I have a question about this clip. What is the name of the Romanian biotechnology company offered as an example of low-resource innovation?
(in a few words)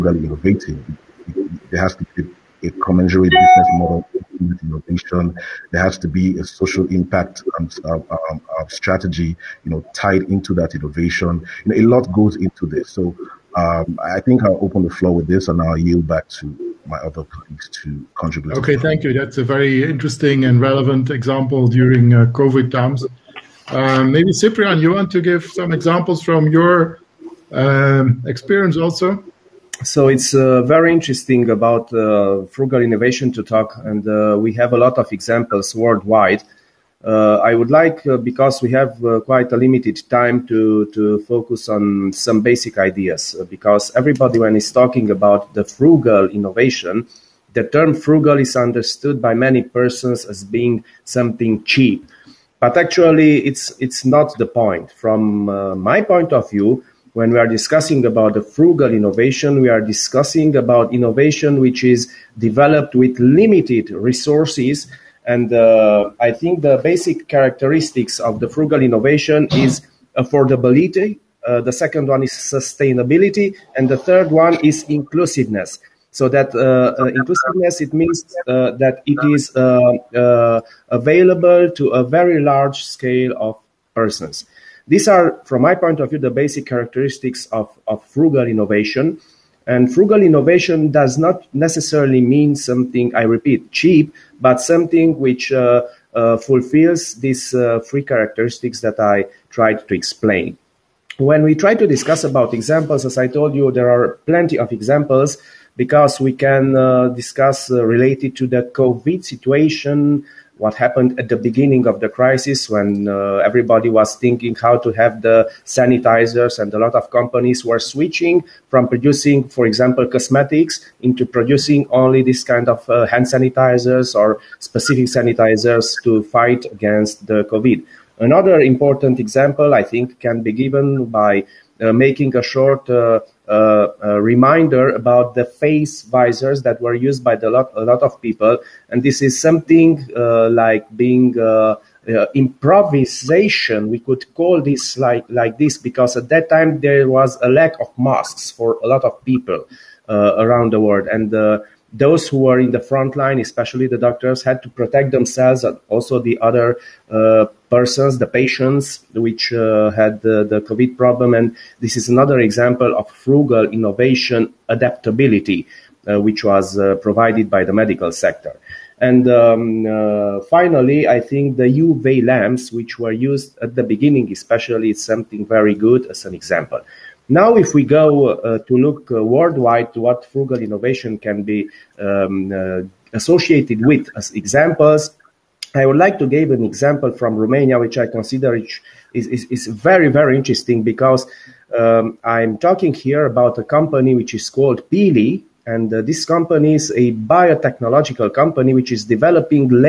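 Pili.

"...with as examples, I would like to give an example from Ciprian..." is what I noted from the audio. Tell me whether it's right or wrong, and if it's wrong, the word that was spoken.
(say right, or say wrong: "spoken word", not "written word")
wrong: "Romania", not "Ciprian".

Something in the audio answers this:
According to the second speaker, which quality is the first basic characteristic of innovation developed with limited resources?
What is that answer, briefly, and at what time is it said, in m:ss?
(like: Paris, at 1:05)
Affordability, at 1:10.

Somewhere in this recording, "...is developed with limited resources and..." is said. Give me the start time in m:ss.
1:01.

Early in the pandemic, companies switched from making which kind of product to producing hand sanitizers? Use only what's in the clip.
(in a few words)
Cosmetics.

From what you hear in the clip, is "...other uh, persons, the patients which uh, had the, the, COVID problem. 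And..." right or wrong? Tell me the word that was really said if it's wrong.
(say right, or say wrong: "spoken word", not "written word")
right.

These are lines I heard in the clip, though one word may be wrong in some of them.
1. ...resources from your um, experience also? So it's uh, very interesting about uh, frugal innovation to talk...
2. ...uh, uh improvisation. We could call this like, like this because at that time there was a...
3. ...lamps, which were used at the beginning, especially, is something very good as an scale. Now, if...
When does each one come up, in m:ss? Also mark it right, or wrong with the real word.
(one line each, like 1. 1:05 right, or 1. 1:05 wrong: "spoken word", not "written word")
1. 0:25 wrong: "examples", not "resources"
2. 2:21 right
3. 2:52 wrong: "example", not "scale".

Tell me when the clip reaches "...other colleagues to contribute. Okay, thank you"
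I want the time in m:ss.
0:16.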